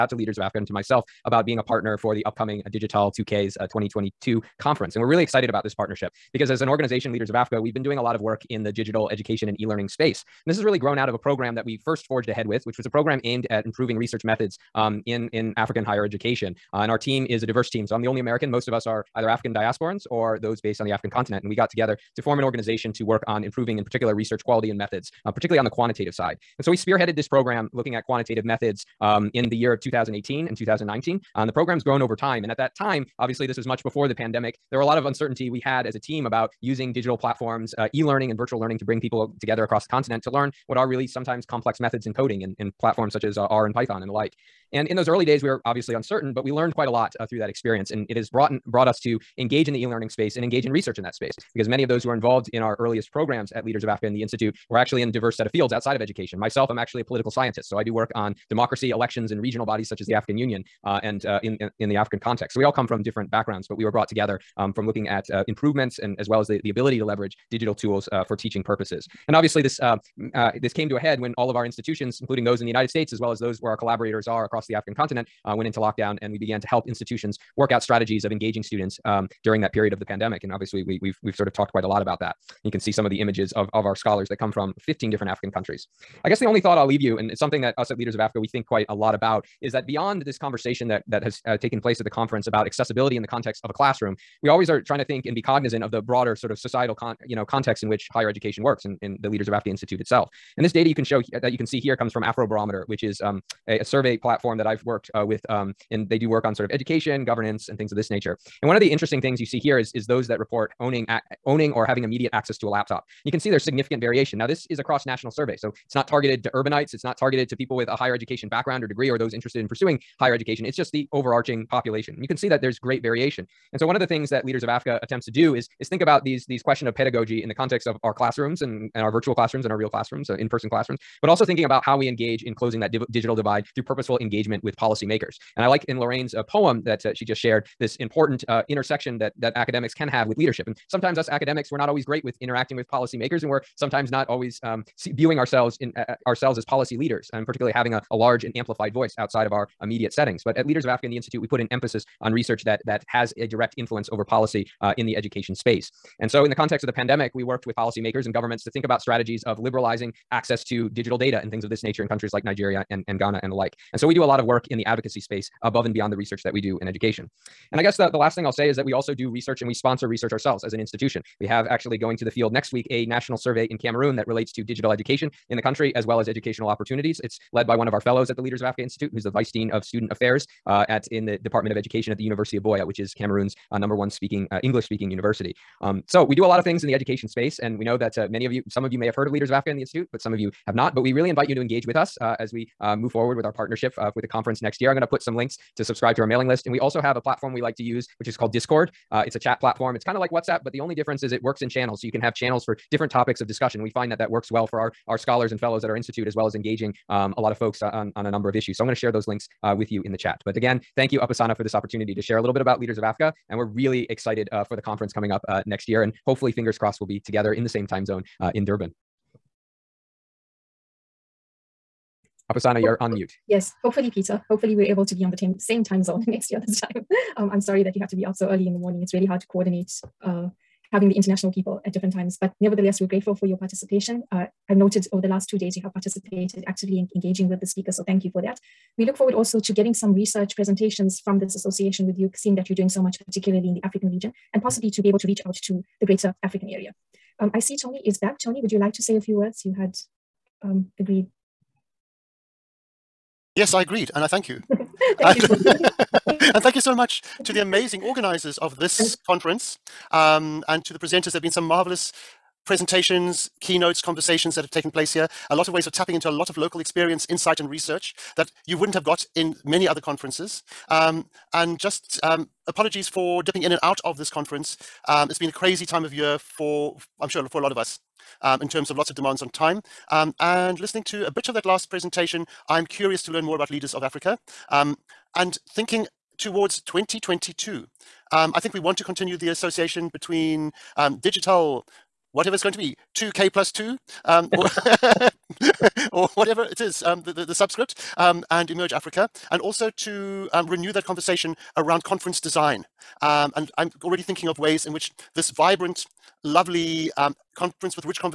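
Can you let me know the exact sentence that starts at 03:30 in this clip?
But again, thank you, Upasana, for this opportunity to share a little bit about Leaders of Africa.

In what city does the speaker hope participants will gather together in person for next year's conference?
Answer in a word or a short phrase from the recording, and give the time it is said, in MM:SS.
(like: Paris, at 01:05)
Durban, at 03:38.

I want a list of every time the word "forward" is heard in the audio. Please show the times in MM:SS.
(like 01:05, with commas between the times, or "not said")
03:13, 03:59.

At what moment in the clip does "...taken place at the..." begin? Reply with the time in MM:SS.
01:31.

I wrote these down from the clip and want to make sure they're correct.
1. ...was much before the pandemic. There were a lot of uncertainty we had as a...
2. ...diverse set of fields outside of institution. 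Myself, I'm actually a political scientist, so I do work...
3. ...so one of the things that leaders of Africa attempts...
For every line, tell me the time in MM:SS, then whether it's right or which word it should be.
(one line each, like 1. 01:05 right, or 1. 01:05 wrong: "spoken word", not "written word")
1. 00:33 right
2. 00:55 wrong: "education", not "institution"
3. 02:03 right.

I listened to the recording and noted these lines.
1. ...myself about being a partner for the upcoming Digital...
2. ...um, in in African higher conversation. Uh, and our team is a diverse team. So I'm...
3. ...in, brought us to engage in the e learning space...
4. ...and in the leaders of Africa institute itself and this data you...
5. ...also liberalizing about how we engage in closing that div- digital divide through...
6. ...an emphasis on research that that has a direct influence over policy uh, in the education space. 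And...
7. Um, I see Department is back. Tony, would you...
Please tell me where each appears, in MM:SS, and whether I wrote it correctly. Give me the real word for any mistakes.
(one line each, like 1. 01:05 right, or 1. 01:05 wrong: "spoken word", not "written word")
1. 00:00 right
2. 00:14 wrong: "education", not "conversation"
3. 00:48 right
4. 01:38 right
5. 02:11 wrong: "thinking", not "liberalizing"
6. 02:31 right
7. 04:07 wrong: "Tony", not "Department".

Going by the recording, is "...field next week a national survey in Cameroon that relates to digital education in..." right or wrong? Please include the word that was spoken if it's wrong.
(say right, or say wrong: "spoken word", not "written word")
right.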